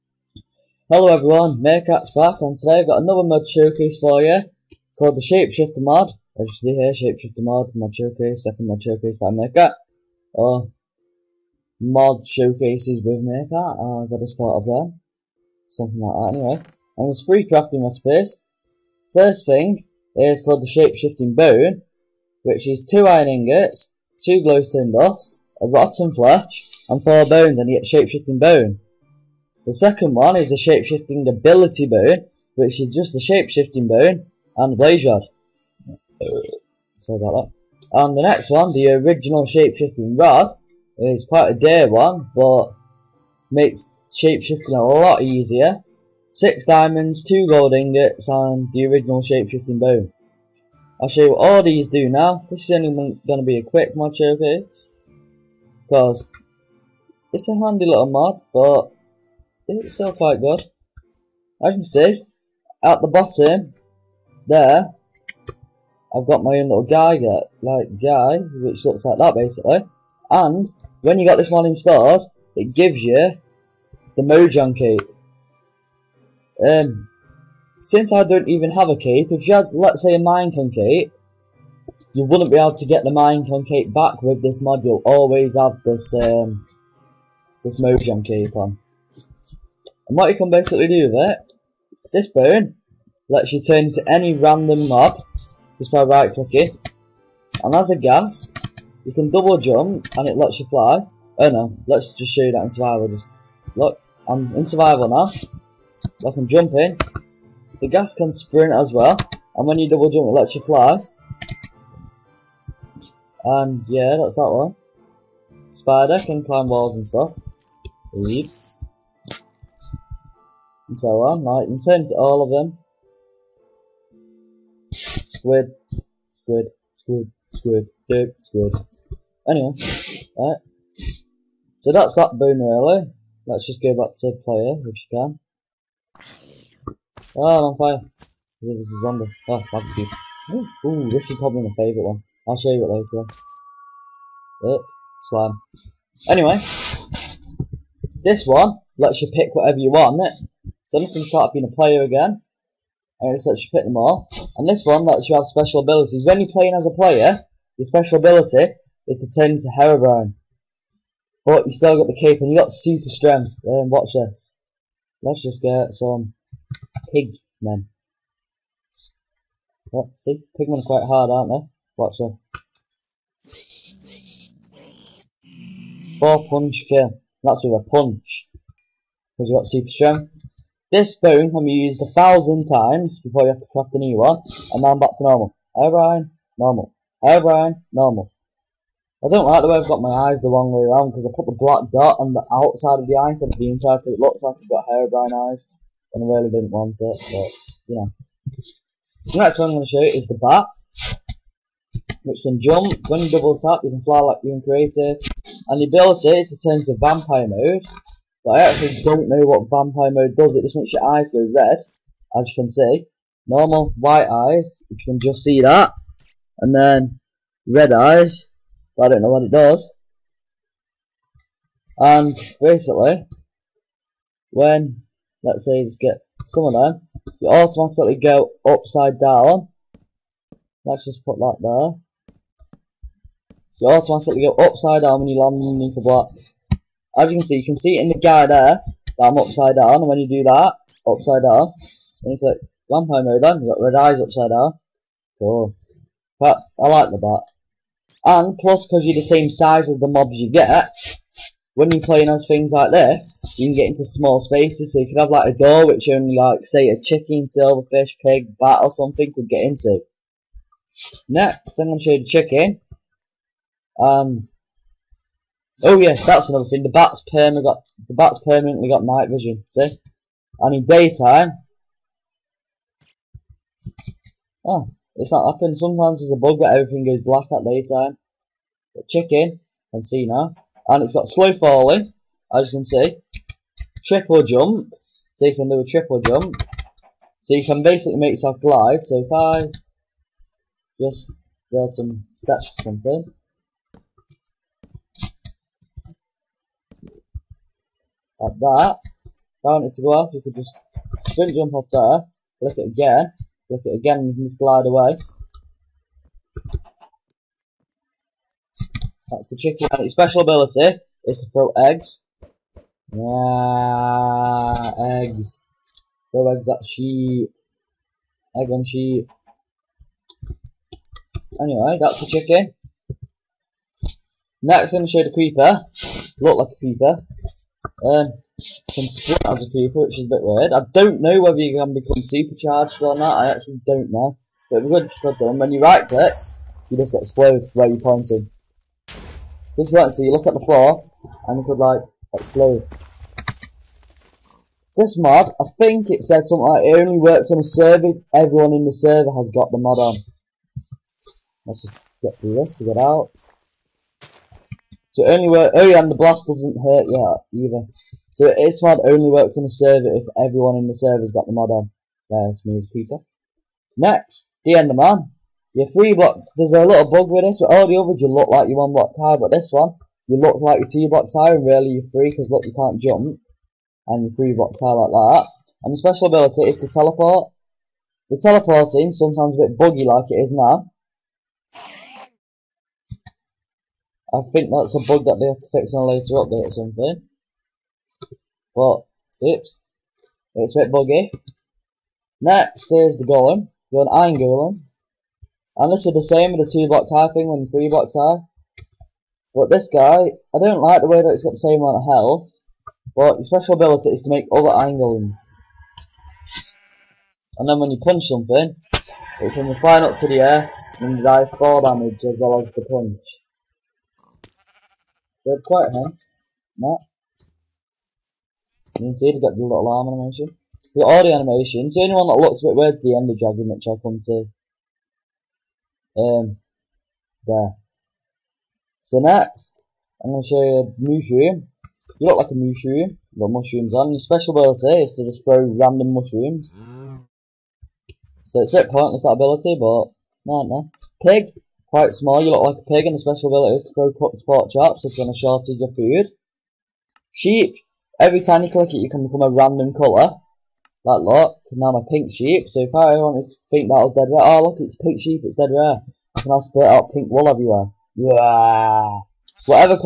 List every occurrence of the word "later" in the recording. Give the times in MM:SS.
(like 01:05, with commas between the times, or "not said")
02:22, 06:26.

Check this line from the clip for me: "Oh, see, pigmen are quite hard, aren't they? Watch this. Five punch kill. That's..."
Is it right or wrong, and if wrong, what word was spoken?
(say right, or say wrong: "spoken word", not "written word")
wrong: "Four", not "Five".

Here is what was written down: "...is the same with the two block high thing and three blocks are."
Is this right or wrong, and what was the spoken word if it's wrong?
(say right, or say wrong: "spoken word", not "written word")
right.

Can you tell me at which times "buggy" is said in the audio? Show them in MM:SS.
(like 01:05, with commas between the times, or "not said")
06:19, 06:30.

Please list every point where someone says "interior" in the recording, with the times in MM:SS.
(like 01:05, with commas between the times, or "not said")
not said.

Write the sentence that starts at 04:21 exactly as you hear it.
Next, I'm gonna show you the chicken.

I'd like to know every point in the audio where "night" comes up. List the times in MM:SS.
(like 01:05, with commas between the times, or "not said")
04:29.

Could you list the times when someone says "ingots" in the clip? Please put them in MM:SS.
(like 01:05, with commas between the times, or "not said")
00:23, 00:47.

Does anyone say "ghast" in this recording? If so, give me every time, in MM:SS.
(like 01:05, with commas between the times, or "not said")
01:37, 01:47.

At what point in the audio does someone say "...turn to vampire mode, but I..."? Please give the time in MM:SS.
03:26.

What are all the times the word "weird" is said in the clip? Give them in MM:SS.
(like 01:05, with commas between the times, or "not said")
05:30, 07:02.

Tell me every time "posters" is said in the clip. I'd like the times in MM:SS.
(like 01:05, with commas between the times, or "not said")
not said.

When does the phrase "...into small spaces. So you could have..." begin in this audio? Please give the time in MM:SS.
04:13.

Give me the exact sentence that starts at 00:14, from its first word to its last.
as I just thought of them.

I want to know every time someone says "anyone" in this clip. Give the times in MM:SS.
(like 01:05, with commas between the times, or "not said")
07:02.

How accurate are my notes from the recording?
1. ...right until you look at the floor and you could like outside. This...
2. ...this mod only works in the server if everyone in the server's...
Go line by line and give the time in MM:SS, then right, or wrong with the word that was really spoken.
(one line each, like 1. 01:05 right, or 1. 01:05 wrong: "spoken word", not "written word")
1. 05:39 wrong: "explode", not "outside"
2. 05:58 right.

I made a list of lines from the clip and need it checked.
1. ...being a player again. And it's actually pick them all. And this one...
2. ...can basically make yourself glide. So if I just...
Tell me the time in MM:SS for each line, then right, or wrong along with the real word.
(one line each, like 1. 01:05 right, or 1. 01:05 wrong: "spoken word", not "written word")
1. 02:31 right
2. 04:47 right.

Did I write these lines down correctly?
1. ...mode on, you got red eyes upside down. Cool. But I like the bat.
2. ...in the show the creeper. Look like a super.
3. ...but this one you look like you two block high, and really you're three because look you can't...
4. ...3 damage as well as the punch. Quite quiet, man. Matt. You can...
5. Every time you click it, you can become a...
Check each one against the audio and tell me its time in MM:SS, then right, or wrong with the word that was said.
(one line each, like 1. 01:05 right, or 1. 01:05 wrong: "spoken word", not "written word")
1. 04:03 right
2. 05:24 wrong: "creeper", not "super"
3. 06:09 right
4. 06:51 wrong: "4", not "3"
5. 07:28 right.